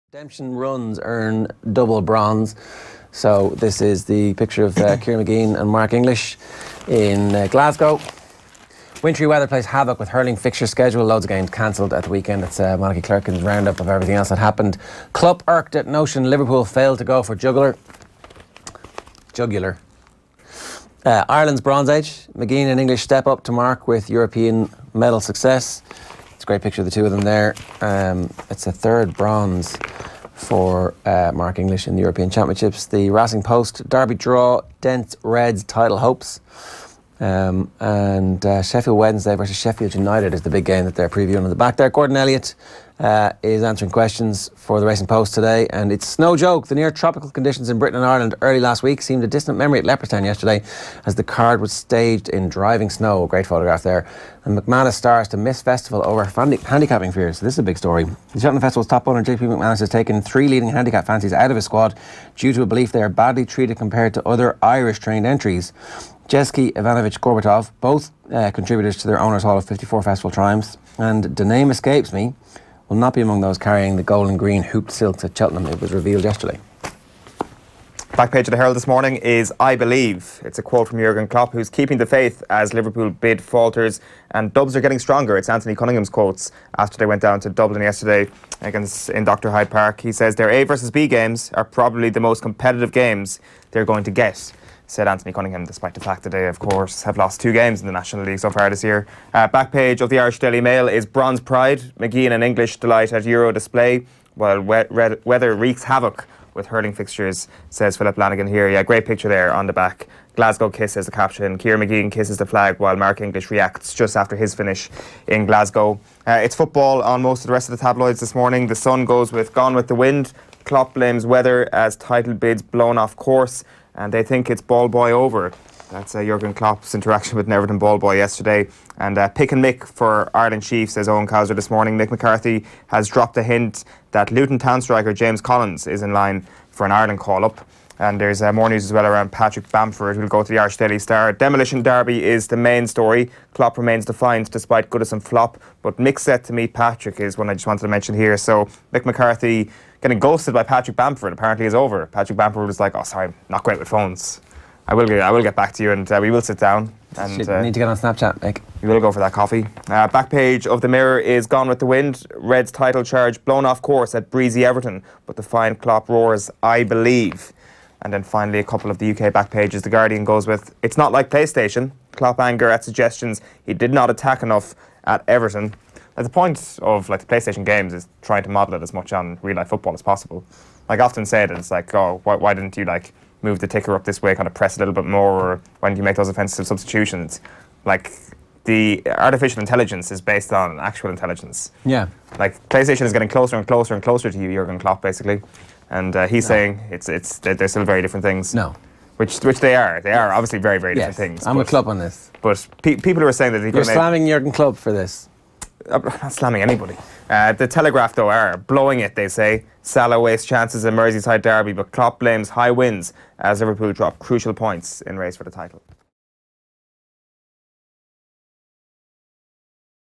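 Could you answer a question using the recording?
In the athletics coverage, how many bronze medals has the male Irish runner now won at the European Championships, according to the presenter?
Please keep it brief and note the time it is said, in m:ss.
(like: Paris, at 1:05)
3, at 0:28.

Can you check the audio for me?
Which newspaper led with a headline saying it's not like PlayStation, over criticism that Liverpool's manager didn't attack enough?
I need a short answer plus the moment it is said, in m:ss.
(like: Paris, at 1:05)
The Guardian, at 2:49.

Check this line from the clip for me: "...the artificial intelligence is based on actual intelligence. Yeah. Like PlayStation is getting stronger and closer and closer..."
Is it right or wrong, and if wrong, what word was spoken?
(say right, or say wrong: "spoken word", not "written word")
wrong: "closer", not "stronger".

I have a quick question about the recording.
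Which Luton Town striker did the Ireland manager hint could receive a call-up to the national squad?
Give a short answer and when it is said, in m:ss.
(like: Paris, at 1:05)
James Collins, at 2:15.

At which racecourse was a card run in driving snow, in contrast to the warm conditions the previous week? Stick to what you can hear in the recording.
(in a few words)
Leopardstown.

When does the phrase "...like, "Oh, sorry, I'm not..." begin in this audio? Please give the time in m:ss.
2:32.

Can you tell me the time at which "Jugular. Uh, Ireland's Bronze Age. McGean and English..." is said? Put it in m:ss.
0:19.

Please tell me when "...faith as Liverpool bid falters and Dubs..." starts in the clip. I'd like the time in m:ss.
1:22.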